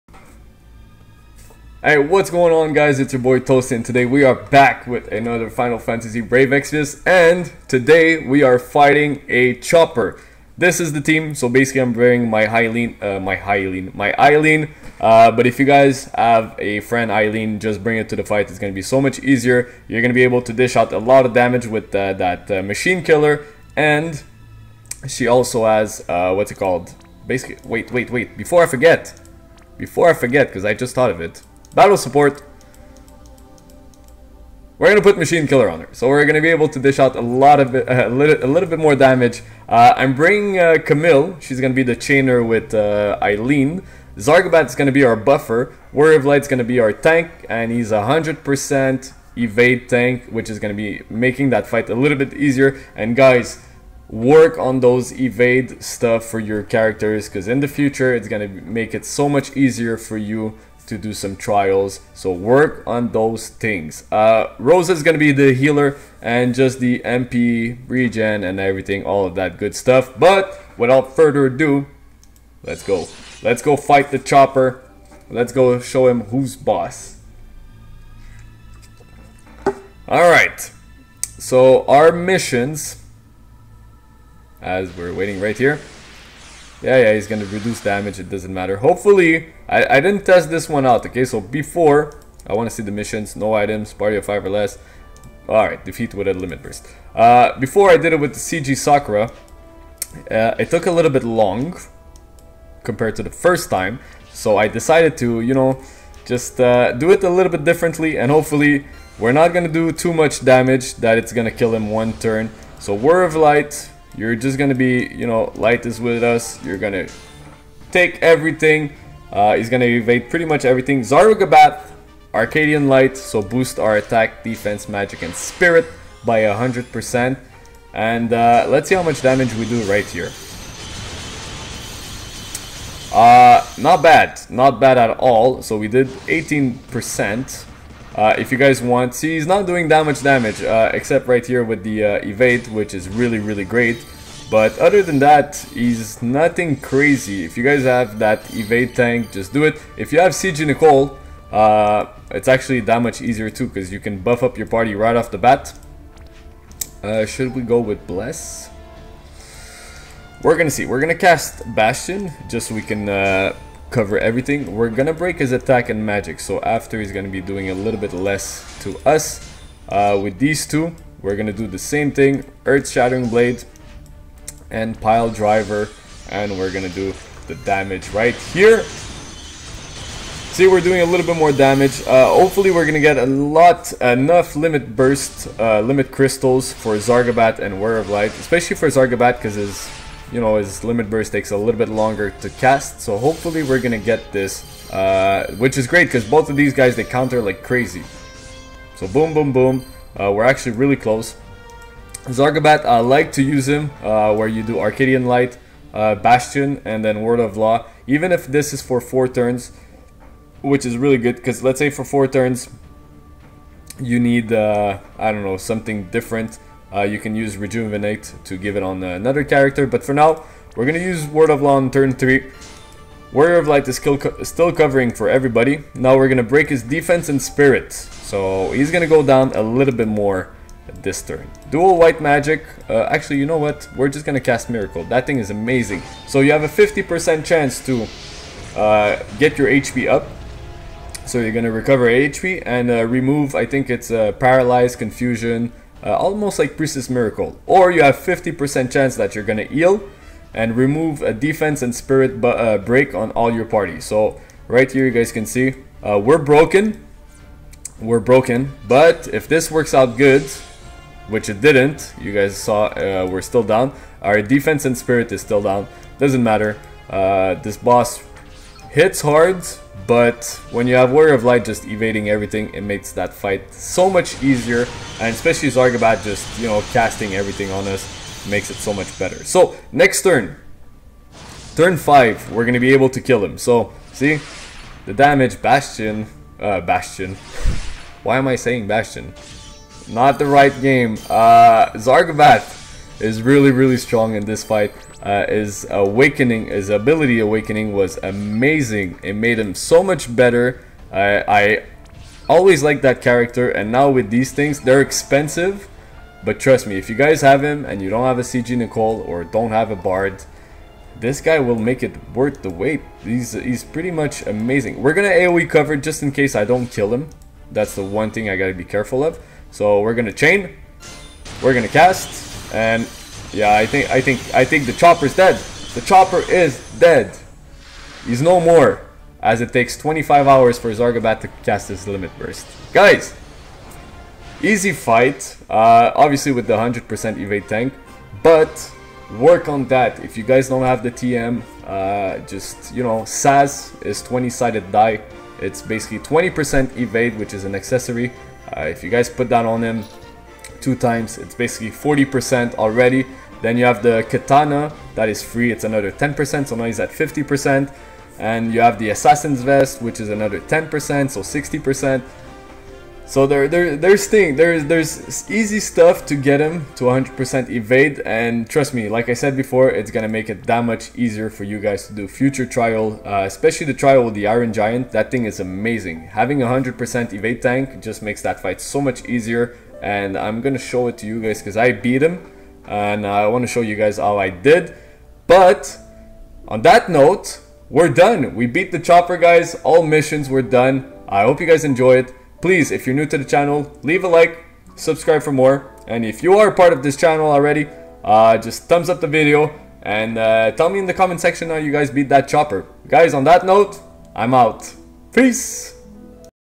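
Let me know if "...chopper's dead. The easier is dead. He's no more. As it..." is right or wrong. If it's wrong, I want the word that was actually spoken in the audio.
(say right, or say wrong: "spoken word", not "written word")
wrong: "chopper", not "easier".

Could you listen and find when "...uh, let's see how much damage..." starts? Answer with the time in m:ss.
2:08.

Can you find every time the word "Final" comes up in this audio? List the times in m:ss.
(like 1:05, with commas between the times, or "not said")
0:05.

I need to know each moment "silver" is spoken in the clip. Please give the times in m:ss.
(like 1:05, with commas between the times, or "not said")
not said.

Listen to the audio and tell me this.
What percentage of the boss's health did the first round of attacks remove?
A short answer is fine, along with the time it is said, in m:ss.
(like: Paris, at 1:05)
18%, at 2:16.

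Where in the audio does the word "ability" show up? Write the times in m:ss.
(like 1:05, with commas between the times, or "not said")
4:56.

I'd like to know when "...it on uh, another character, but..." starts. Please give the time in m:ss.
3:38.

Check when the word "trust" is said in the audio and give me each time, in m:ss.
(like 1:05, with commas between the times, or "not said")
5:06, 6:08.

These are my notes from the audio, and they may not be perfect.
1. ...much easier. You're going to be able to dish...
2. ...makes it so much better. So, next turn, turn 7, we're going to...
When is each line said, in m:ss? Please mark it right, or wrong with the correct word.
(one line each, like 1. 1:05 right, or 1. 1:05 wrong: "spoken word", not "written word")
1. 0:19 right
2. 4:38 wrong: "5", not "7".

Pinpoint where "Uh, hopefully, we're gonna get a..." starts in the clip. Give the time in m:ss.
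3:02.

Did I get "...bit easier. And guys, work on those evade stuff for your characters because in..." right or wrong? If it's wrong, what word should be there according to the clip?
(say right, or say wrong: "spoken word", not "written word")
right.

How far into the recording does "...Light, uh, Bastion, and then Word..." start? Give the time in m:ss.
3:25.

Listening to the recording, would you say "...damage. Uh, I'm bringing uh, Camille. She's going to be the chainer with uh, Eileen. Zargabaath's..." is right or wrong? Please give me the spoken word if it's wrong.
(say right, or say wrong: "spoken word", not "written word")
right.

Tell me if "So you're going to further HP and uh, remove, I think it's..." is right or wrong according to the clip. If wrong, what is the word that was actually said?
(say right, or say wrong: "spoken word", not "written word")
wrong: "recover", not "further".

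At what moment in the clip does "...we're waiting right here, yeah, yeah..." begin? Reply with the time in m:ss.
1:24.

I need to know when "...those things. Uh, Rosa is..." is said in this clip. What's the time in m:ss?
1:03.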